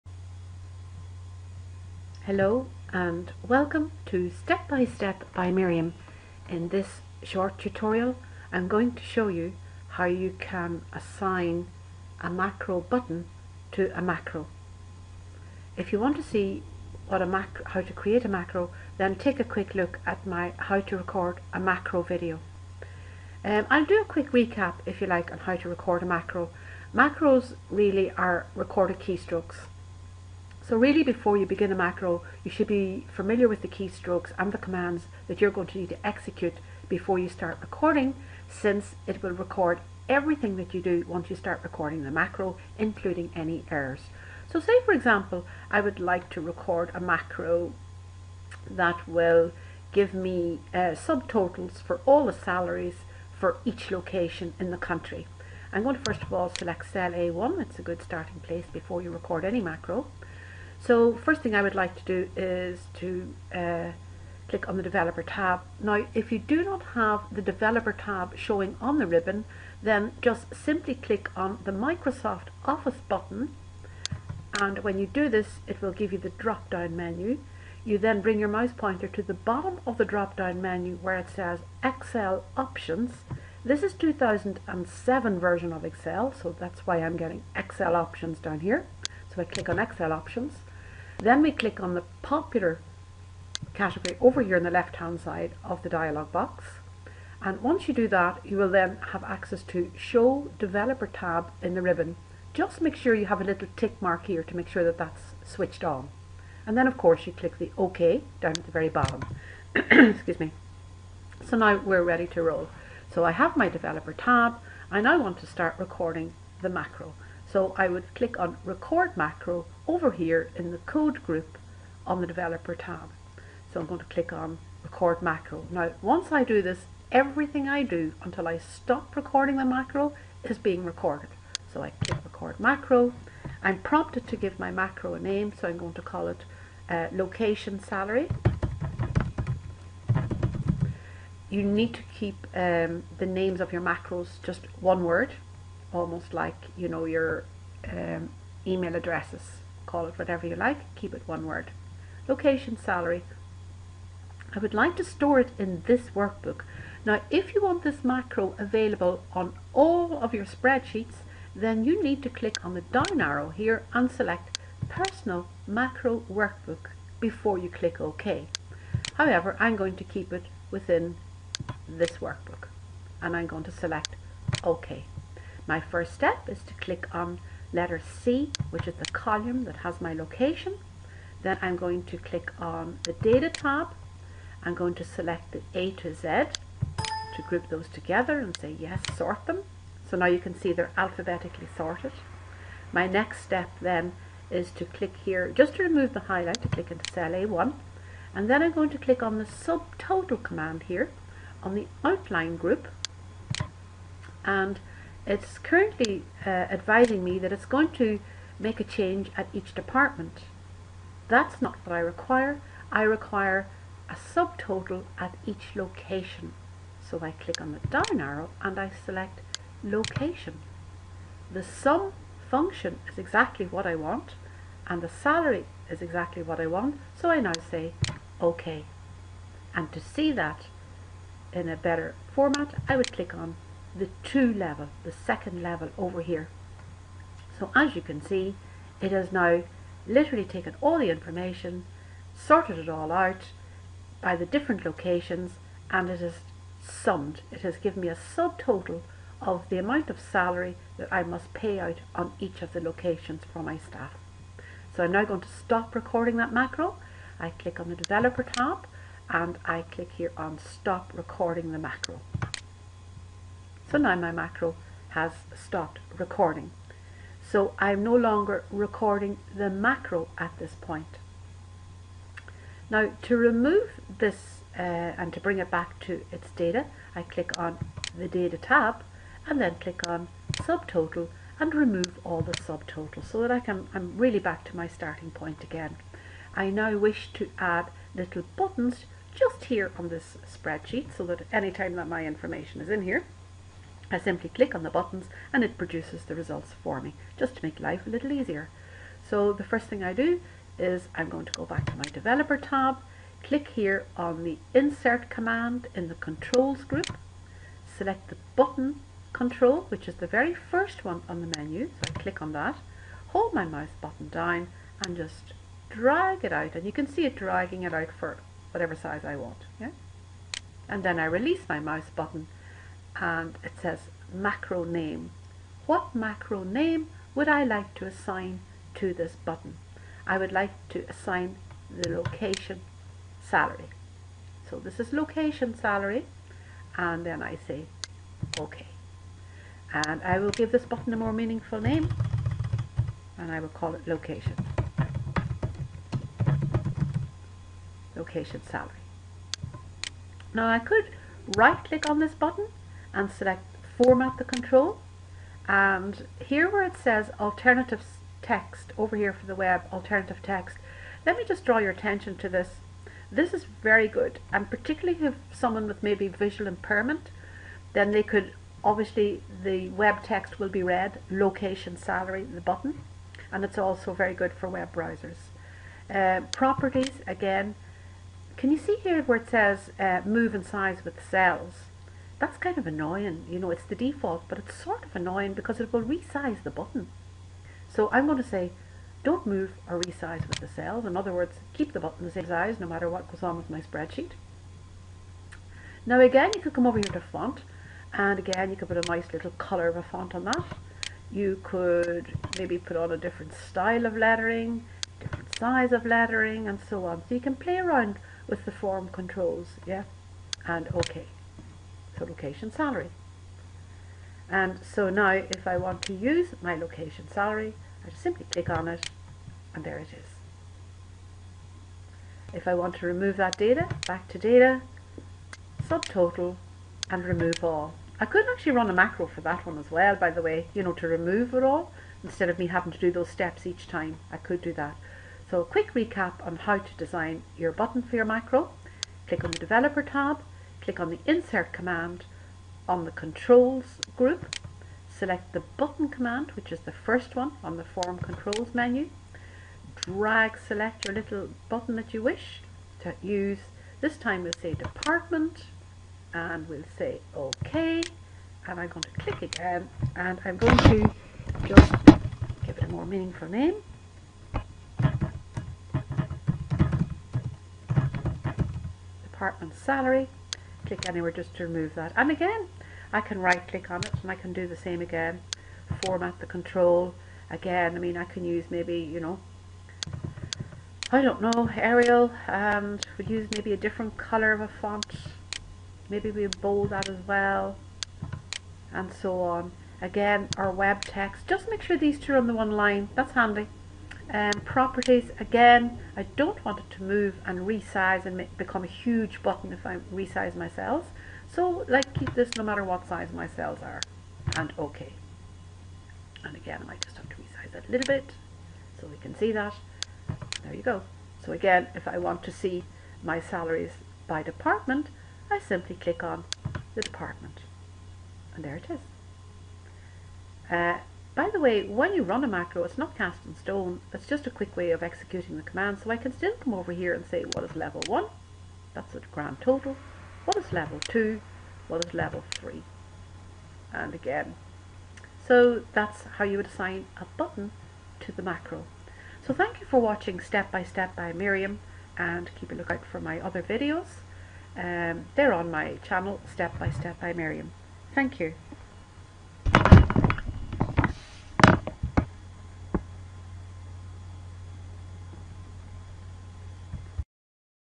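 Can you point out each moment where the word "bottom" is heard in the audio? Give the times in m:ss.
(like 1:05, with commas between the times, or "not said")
1:19, 1:48.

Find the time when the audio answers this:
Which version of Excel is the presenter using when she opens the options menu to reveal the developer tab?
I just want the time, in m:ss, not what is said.
1:23.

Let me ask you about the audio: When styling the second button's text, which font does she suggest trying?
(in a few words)
Arial.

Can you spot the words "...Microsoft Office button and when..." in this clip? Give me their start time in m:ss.
1:11.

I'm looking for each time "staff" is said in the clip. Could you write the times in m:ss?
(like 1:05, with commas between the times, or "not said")
4:13.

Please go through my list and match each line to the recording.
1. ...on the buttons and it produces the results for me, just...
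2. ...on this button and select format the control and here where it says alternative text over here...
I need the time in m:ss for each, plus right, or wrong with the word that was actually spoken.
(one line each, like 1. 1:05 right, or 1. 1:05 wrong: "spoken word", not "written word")
1. 4:54 right
2. 5:52 right.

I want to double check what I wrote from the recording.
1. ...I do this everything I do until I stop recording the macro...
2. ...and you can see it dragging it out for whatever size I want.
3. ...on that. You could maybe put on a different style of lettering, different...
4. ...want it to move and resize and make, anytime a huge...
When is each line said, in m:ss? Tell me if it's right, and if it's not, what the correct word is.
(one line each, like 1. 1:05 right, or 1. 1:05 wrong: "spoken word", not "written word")
1. 2:06 right
2. 5:16 right
3. 6:40 right
4. 8:16 wrong: "become", not "anytime".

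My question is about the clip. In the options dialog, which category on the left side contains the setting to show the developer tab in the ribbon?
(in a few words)
Popular.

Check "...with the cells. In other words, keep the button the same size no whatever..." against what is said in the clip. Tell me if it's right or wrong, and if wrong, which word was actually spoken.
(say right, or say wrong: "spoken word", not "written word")
wrong: "matter", not "whatever".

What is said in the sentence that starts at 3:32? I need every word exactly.
I require a subtotal at each location.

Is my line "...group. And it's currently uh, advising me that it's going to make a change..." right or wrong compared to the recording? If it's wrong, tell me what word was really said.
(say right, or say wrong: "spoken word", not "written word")
right.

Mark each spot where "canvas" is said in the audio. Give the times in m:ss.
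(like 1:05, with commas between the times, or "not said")
not said.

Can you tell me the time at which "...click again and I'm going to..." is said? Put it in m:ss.
7:39.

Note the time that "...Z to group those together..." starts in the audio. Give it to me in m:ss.
3:06.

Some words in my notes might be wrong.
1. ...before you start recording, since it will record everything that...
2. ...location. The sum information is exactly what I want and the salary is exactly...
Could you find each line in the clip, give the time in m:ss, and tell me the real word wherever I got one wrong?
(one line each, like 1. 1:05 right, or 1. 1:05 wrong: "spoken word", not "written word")
1. 0:36 right
2. 3:39 wrong: "function", not "information".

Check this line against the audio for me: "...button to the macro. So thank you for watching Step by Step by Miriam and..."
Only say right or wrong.
right.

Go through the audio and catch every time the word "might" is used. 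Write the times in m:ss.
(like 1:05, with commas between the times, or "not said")
8:26.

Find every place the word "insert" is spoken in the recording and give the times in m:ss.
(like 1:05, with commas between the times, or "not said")
5:04, 7:21.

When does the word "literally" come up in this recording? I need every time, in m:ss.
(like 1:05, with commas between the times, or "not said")
4:00.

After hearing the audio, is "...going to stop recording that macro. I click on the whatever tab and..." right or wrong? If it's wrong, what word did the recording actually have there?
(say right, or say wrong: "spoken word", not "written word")
wrong: "developer", not "whatever".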